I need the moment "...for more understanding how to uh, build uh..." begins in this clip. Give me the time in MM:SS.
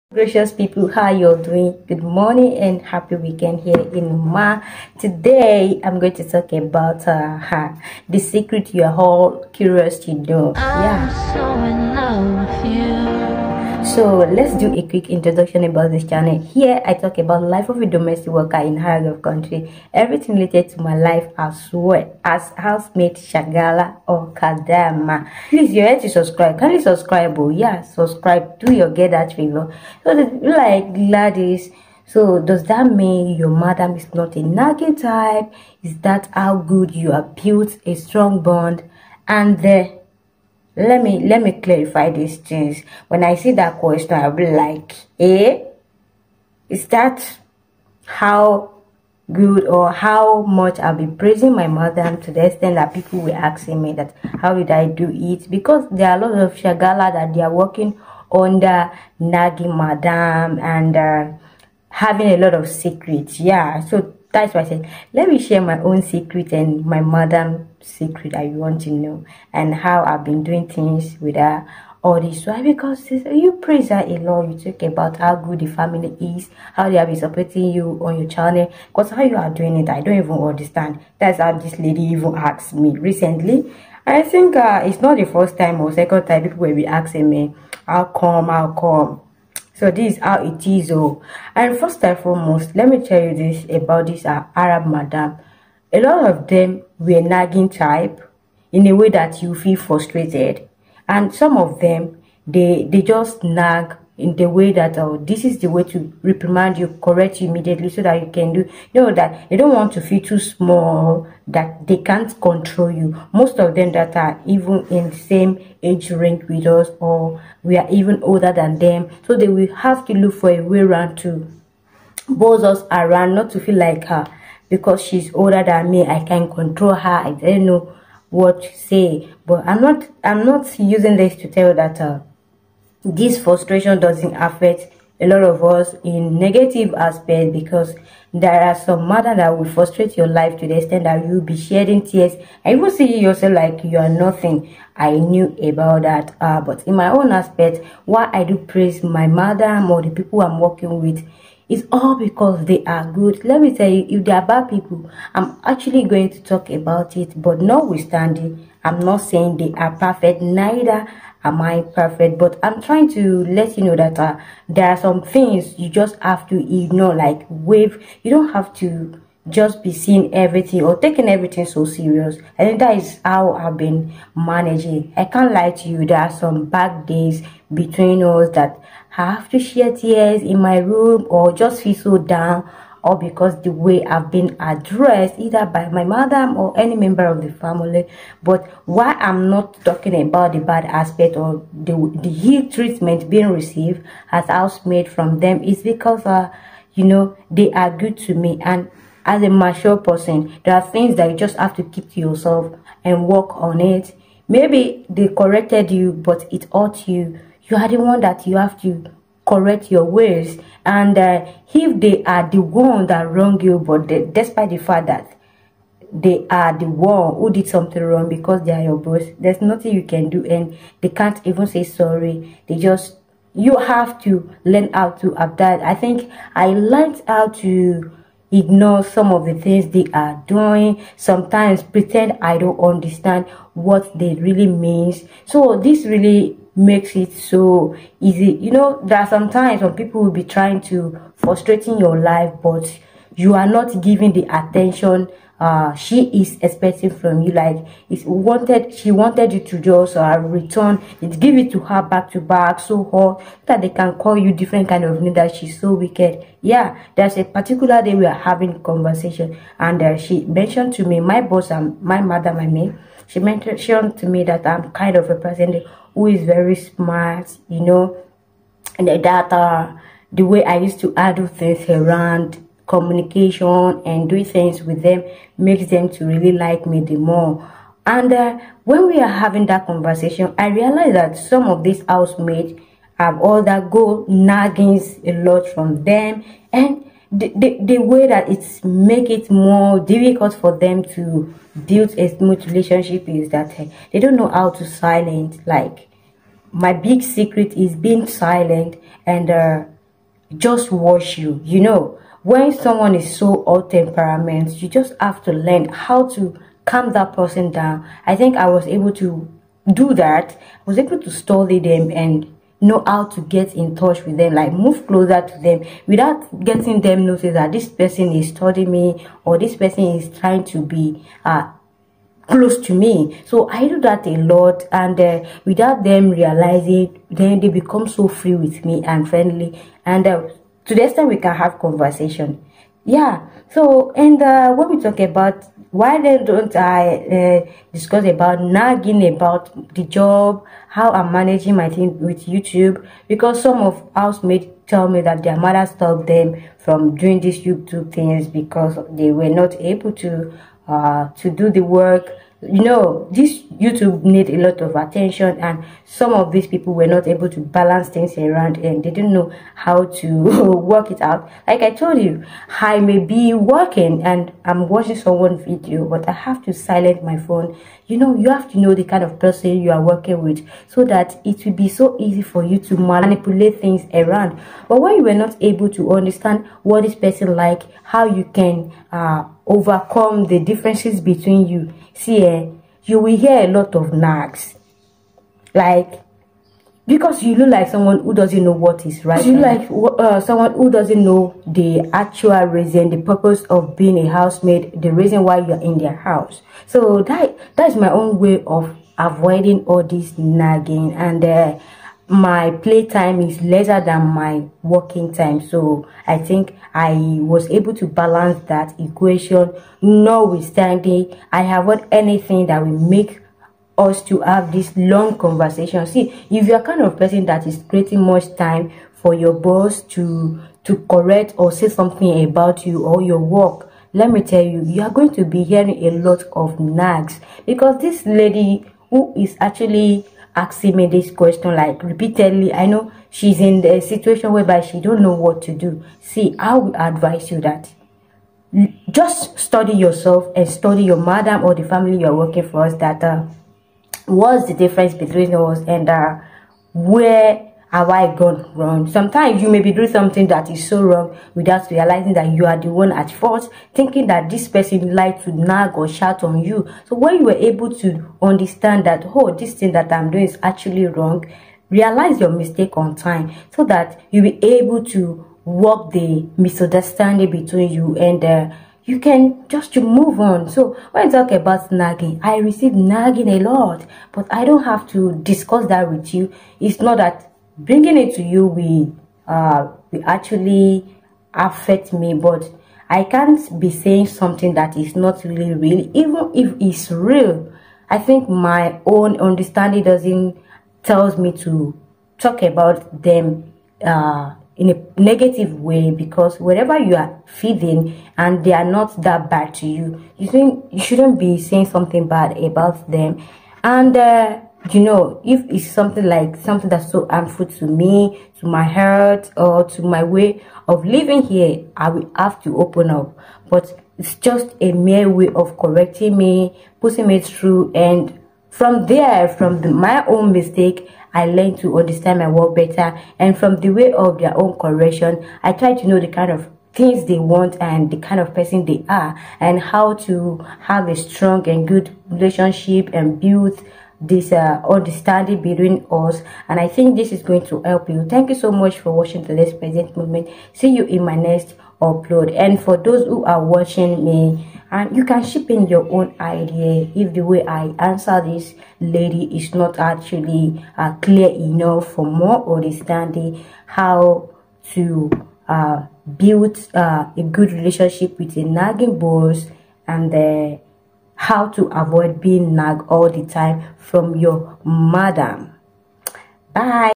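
09:12.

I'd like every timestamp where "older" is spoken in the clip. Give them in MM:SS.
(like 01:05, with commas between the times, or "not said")
01:58, 02:05.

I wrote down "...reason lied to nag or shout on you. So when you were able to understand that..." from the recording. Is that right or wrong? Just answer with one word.
wrong.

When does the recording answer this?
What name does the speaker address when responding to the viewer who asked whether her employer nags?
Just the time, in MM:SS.
00:30.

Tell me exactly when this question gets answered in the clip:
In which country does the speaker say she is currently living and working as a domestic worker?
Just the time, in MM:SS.
00:04.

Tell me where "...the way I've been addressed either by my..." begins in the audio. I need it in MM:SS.
03:03.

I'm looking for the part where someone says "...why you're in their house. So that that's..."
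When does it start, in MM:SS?
06:35.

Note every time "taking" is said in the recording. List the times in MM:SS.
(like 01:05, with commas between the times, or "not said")
02:50.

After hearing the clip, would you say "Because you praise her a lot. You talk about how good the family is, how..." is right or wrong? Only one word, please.
right.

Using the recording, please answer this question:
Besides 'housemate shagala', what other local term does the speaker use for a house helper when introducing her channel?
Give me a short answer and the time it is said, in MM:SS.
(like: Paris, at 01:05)
kadama, at 00:24.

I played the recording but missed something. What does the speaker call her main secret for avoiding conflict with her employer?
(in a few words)
being silent.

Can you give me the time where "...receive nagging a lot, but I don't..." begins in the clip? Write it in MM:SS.
07:52.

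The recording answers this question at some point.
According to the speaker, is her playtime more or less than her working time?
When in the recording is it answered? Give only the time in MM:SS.
06:43.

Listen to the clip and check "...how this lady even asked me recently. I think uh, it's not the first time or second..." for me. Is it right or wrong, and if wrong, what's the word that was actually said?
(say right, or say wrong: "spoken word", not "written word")
right.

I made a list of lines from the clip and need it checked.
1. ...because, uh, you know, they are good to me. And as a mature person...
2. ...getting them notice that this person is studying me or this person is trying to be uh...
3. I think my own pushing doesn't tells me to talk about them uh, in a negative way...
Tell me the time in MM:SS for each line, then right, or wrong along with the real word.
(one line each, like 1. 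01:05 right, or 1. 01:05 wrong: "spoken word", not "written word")
1. 03:15 right
2. 05:16 right
3. 08:08 wrong: "understanding", not "pushing".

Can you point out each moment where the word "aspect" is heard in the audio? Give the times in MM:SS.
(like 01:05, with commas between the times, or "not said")
02:16, 02:27, 03:10.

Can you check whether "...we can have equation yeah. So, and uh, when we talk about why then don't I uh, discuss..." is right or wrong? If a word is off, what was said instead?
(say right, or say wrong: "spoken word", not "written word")
wrong: "conversation", not "equation".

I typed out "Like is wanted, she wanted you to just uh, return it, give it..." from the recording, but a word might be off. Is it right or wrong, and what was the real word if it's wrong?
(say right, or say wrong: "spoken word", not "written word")
right.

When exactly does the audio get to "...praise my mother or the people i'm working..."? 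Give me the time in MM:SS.
02:28.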